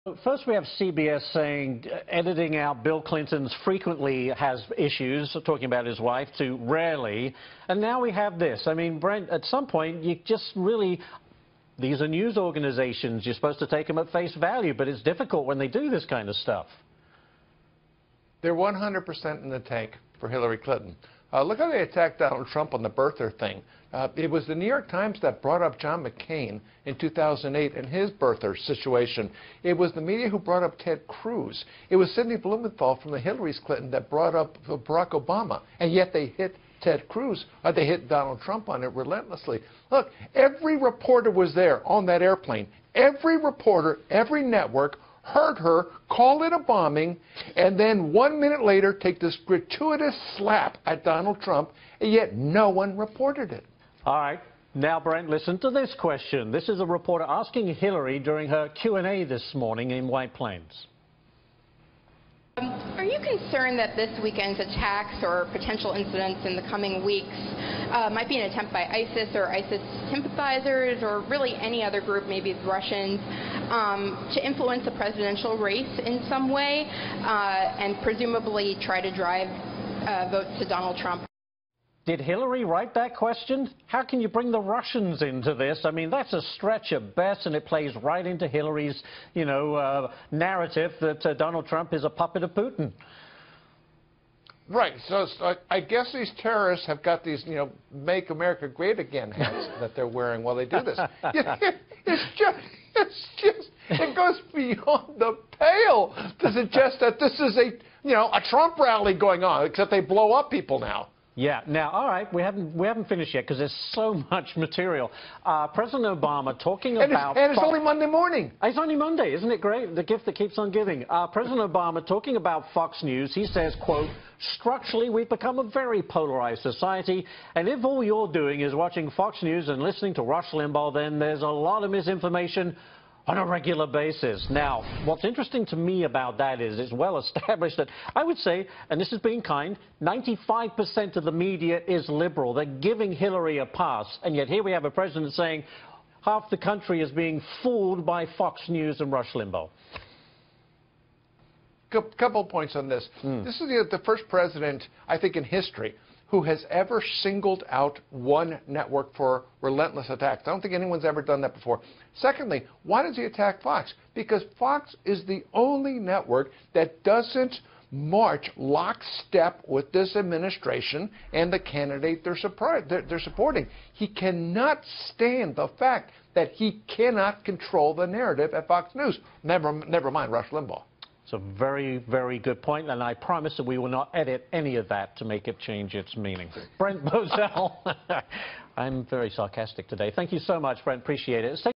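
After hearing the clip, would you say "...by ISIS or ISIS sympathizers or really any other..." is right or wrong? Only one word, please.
right.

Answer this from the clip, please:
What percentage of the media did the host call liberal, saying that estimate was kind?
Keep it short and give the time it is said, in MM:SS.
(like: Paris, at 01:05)
95%, at 02:20.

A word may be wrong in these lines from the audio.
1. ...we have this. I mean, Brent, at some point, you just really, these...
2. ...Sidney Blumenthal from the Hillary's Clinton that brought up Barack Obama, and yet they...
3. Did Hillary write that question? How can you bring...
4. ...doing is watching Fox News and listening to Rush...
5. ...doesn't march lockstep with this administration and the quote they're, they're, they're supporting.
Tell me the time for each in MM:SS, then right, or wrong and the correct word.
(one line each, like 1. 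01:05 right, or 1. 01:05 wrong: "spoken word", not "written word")
1. 00:08 right
2. 00:32 right
3. 01:22 right
4. 02:08 right
5. 02:47 wrong: "candidate", not "quote".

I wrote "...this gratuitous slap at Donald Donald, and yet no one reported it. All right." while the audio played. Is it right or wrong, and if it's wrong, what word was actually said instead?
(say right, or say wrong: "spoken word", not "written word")
wrong: "Trump", not "Donald".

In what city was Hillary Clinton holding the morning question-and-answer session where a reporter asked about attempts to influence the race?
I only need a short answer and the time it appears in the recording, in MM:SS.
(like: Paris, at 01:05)
White Plains, at 01:00.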